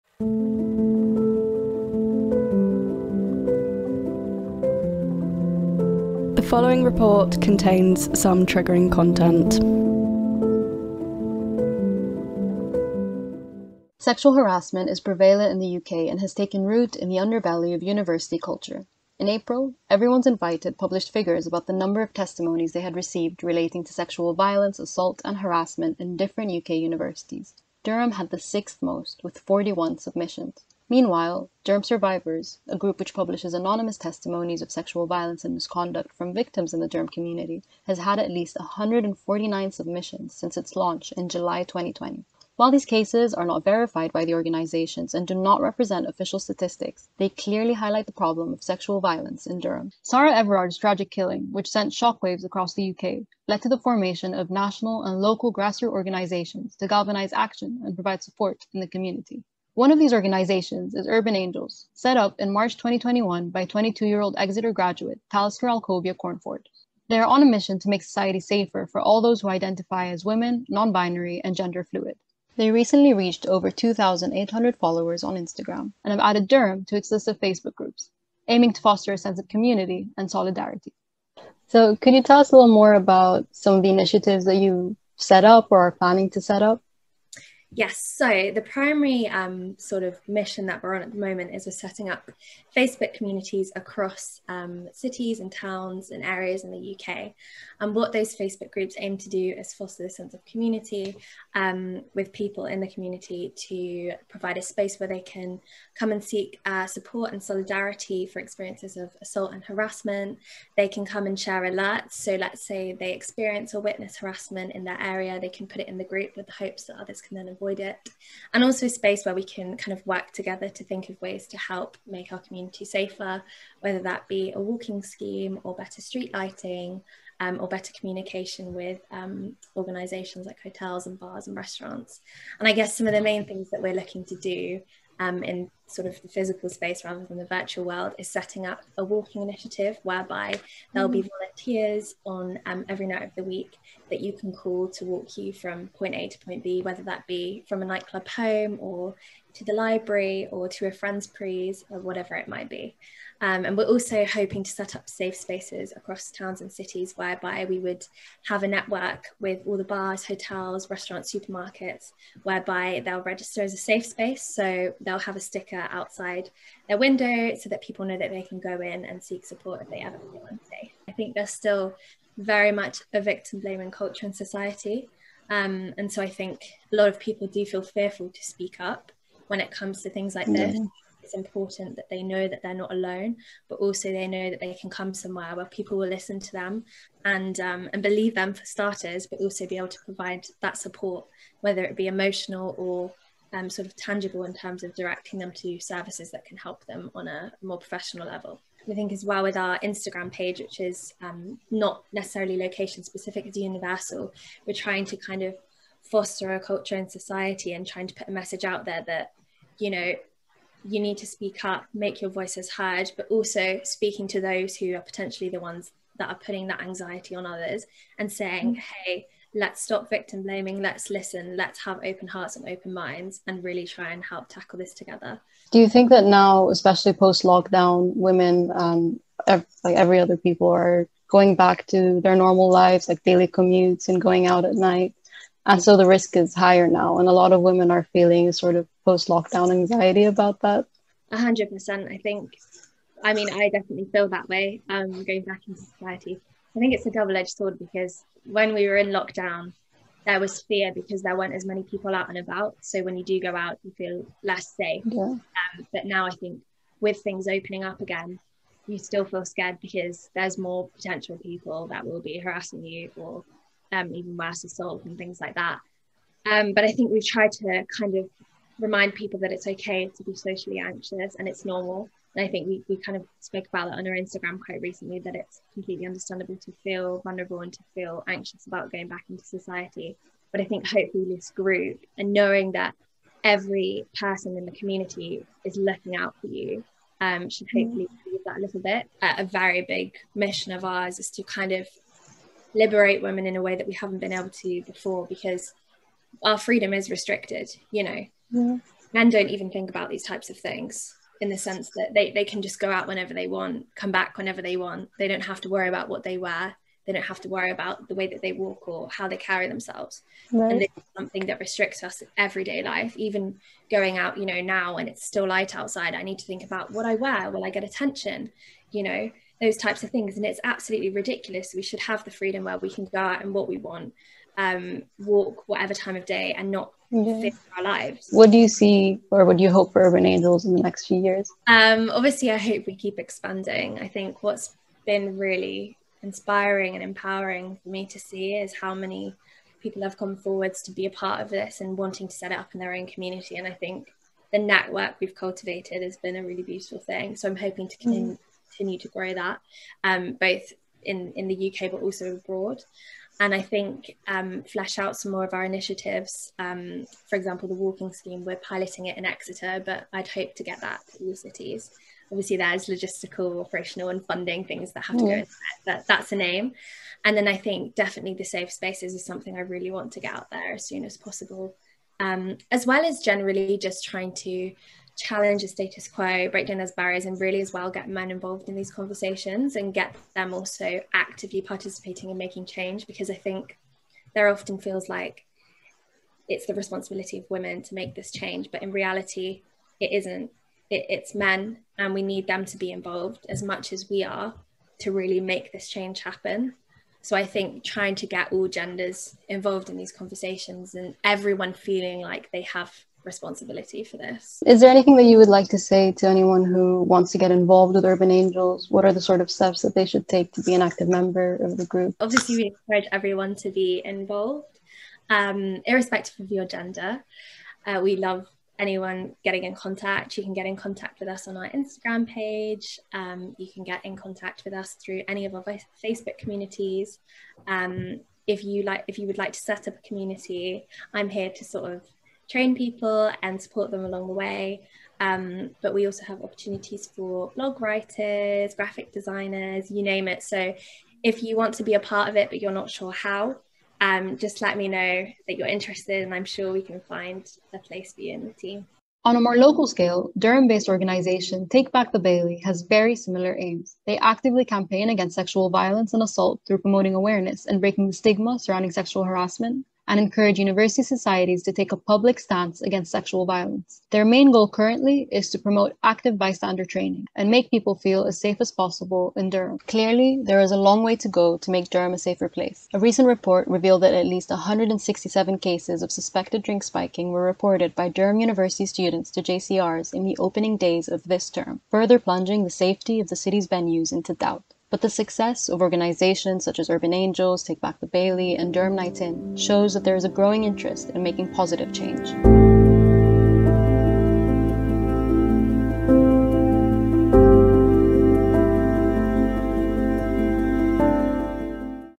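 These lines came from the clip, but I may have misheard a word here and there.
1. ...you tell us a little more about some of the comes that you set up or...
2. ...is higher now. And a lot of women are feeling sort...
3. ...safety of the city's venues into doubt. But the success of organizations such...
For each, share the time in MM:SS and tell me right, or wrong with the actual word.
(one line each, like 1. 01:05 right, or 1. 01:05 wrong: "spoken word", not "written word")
1. 01:22 wrong: "initiatives", not "comes"
2. 03:56 right
3. 08:02 right.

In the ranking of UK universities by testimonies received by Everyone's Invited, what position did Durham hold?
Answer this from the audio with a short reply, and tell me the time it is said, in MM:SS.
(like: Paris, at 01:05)
sixth, at 00:28.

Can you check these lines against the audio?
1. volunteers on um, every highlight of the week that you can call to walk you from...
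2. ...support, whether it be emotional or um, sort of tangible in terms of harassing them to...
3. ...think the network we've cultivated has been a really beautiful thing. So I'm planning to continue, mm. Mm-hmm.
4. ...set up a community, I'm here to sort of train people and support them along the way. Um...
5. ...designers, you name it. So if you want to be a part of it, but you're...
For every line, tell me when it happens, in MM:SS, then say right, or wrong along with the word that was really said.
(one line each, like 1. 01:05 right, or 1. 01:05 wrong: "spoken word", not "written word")
1. 02:21 wrong: "night", not "highlight"
2. 03:10 wrong: "directing", not "harassing"
3. 05:43 wrong: "hoping", not "planning"
4. 07:09 right
5. 07:19 right.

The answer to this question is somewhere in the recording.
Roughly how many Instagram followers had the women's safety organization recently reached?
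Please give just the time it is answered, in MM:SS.
01:13.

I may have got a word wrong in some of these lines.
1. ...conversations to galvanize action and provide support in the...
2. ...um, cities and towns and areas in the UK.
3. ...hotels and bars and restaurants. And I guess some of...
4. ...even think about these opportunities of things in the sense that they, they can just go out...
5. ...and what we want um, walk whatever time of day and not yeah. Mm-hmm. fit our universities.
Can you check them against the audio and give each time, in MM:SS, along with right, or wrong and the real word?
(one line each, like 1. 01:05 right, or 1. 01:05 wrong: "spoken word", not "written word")
1. 00:55 wrong: "organizations", not "conversations"
2. 01:34 right
3. 02:10 right
4. 04:59 wrong: "types", not "opportunities"
5. 05:23 wrong: "lives", not "universities".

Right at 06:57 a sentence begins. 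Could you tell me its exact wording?
Uh, we love anyone getting in contact.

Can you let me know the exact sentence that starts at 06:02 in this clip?
Obviously, there's logistical, operational, and funding things that have to mm.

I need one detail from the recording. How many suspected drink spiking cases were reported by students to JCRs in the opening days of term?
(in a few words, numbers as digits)
167.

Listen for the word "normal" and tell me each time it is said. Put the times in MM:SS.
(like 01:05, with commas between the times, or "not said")
03:52, 04:31.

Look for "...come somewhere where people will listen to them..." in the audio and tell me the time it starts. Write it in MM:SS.
03:04.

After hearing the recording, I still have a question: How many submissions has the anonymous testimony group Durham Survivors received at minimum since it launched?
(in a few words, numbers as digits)
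149.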